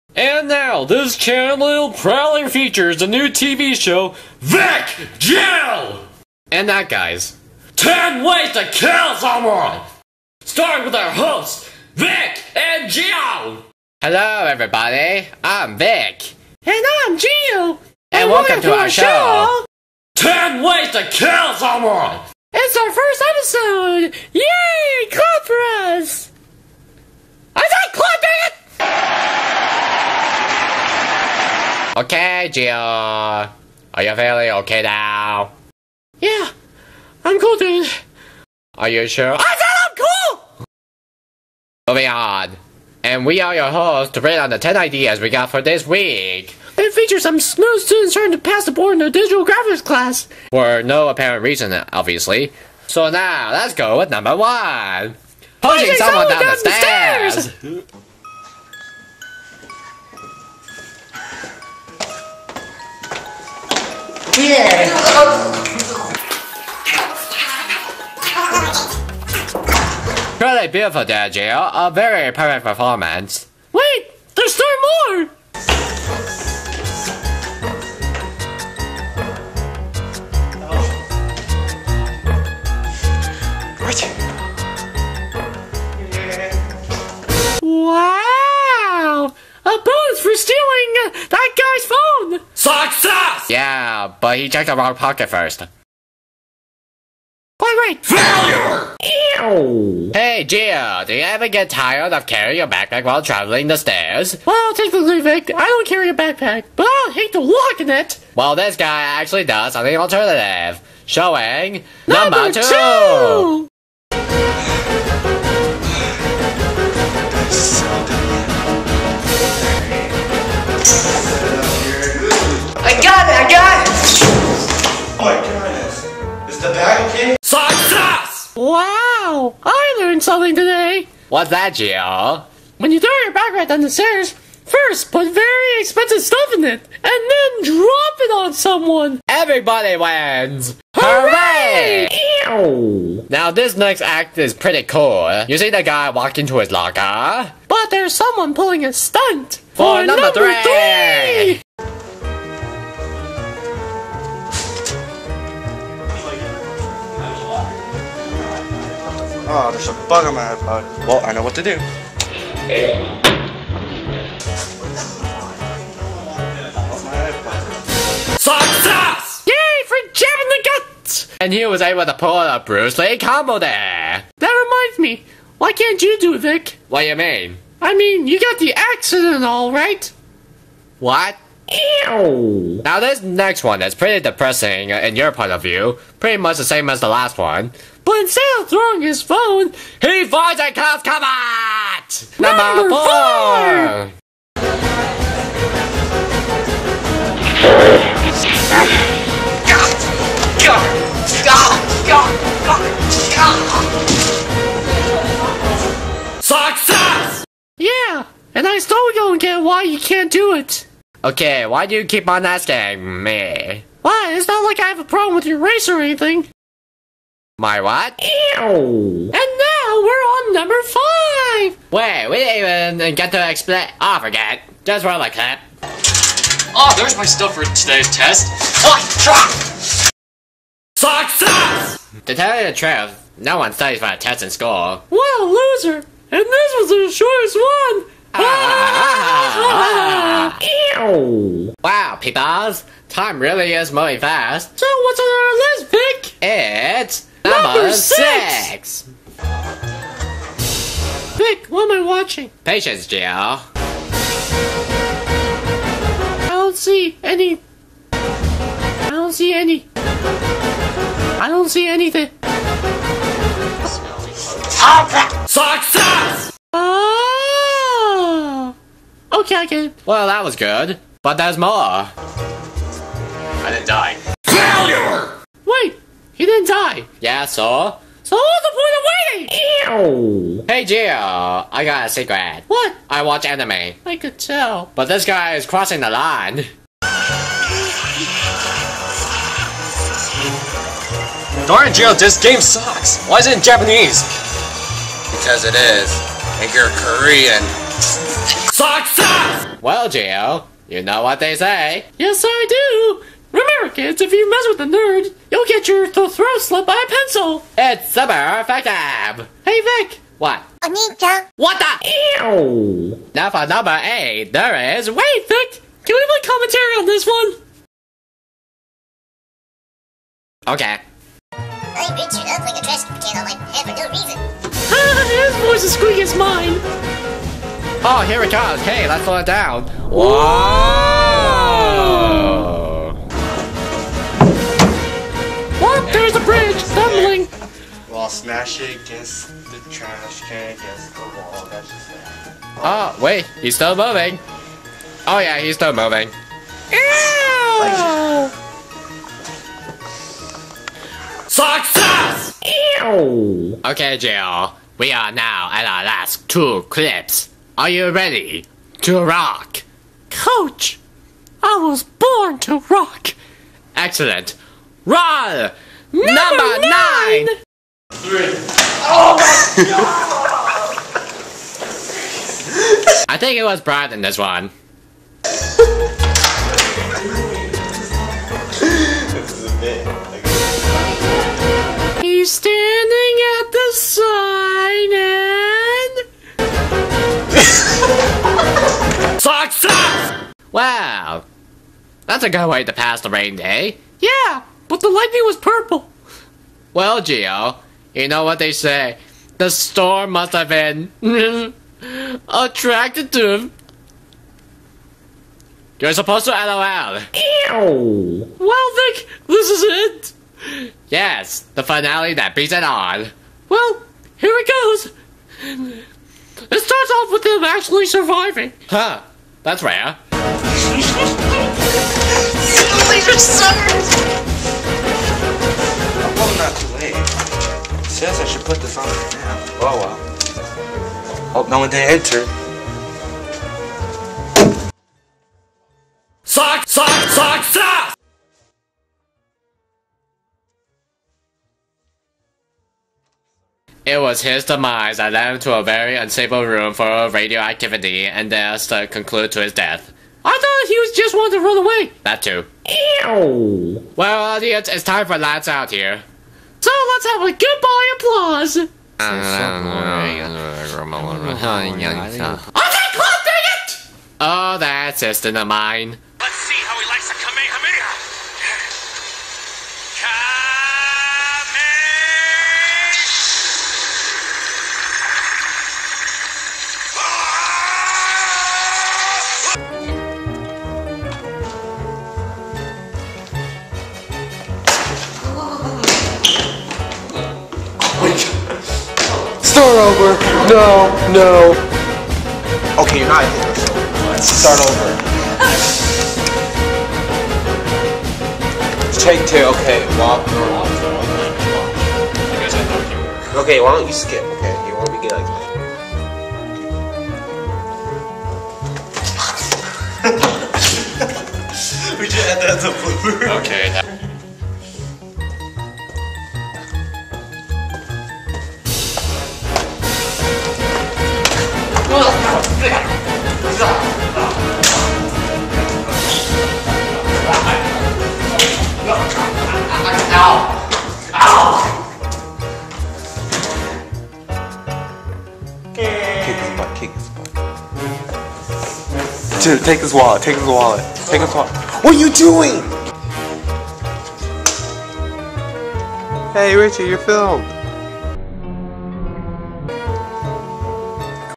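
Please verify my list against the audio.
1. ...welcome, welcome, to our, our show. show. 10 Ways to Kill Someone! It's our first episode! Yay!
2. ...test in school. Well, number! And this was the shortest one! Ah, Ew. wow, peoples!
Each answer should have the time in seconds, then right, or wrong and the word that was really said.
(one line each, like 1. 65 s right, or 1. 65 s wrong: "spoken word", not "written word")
1. 18 s right
2. 234 s wrong: "loser", not "number".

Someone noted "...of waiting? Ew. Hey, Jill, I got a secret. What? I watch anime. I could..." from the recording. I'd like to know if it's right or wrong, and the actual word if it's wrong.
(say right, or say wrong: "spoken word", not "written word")
right.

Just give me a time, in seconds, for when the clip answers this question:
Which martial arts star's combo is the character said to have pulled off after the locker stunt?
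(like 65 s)
172 s.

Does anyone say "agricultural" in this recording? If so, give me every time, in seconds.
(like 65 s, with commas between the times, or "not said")
not said.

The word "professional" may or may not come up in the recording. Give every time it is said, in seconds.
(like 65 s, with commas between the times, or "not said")
not said.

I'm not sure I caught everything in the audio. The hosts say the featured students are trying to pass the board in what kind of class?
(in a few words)
digital graphics.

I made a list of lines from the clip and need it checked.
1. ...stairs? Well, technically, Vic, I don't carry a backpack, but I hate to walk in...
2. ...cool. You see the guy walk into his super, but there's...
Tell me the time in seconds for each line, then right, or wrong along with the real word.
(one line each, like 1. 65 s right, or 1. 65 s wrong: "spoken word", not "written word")
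1. 103 s right
2. 144 s wrong: "locker", not "super".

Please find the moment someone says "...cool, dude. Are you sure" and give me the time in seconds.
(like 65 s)
37 s.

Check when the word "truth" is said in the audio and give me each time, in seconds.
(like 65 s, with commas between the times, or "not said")
232 s.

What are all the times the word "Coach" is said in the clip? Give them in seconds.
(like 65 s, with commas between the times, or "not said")
360 s.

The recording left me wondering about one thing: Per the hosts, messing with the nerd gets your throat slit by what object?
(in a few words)
pencil.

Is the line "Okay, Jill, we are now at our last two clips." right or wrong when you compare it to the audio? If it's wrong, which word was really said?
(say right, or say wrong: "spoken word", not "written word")
right.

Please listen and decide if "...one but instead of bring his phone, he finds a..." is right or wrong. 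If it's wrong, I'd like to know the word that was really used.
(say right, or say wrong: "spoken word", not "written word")
wrong: "throwing", not "bring".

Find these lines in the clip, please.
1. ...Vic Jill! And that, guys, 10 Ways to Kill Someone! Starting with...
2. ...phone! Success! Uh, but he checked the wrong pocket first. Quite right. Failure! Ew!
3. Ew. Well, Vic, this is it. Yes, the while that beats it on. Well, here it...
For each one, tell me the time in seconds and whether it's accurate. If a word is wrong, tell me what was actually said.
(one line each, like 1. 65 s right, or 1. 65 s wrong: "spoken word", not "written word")
1. 4 s right
2. 92 s right
3. 407 s wrong: "finale", not "while".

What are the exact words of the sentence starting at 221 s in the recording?
Wait, we didn't even get to explain.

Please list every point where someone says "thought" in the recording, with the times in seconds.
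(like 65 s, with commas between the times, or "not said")
450 s.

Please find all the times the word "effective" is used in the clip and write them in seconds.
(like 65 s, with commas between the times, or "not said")
308 s.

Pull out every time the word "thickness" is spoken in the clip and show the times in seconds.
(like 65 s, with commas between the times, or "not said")
not said.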